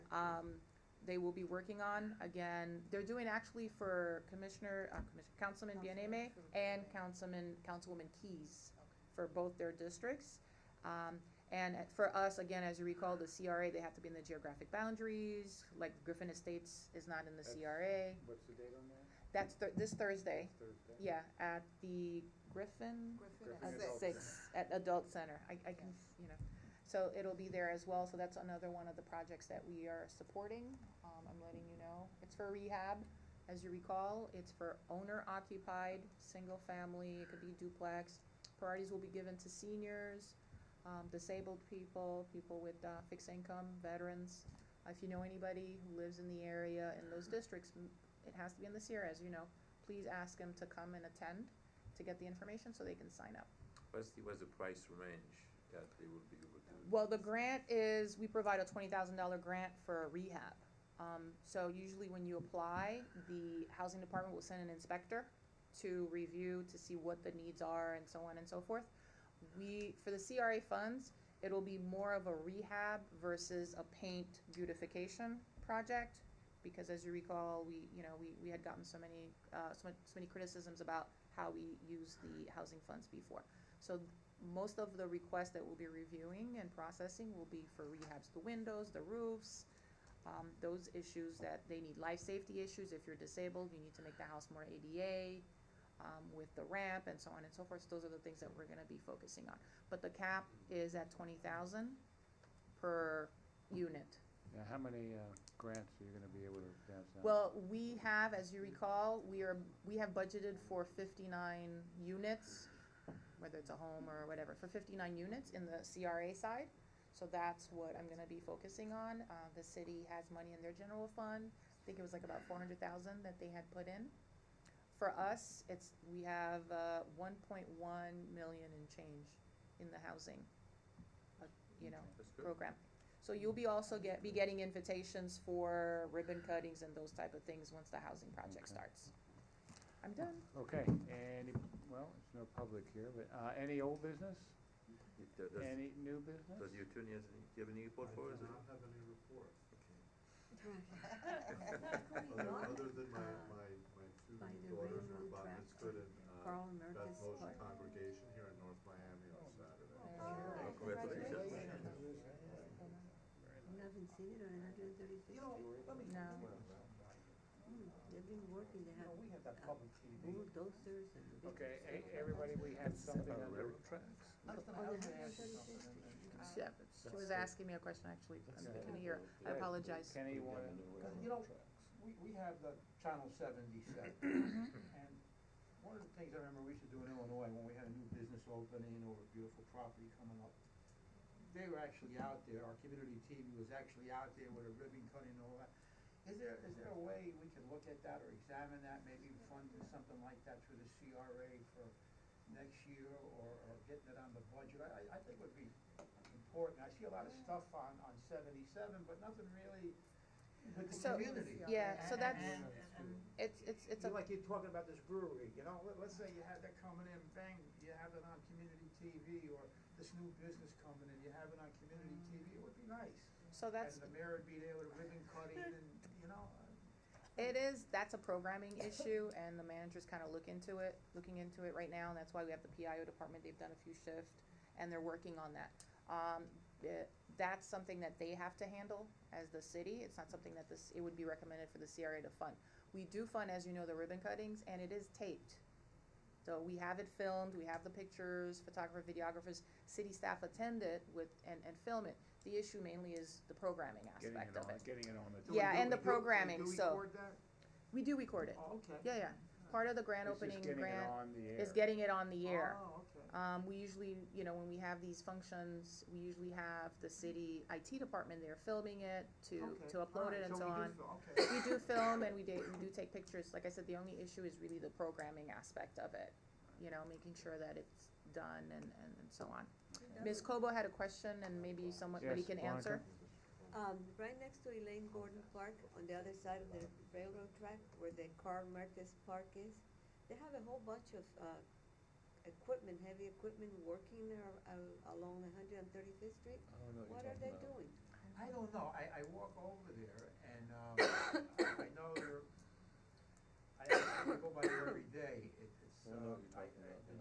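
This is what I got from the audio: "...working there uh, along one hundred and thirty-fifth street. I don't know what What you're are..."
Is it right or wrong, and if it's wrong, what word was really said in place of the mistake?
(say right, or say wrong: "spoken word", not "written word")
right.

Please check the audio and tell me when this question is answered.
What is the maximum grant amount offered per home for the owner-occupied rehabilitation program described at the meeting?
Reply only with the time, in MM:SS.
00:58.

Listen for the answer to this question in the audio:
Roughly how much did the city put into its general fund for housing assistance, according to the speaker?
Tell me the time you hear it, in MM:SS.
02:02.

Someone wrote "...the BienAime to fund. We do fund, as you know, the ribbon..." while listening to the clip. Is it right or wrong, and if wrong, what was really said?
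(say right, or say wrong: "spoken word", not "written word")
wrong: "CRA", not "BienAime".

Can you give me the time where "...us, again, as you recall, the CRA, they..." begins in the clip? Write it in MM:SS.
00:12.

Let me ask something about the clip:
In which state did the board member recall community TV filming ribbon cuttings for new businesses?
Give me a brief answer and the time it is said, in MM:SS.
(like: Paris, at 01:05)
Illinois, at 03:07.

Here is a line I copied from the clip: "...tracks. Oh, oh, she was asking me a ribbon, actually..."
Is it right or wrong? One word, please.
wrong.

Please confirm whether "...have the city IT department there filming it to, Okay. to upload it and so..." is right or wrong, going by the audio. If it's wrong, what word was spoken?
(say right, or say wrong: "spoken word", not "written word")
right.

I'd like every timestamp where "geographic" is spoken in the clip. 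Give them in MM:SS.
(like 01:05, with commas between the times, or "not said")
00:14.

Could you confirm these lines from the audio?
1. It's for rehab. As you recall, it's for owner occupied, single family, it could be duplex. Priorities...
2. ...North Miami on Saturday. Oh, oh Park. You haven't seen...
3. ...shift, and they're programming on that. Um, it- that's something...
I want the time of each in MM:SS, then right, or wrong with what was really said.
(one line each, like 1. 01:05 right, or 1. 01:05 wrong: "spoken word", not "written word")
1. 00:32 right
2. 02:38 wrong: "Congratulations", not "Park"
3. 03:53 wrong: "working", not "programming".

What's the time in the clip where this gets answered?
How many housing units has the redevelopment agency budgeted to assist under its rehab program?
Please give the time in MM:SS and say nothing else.
01:50.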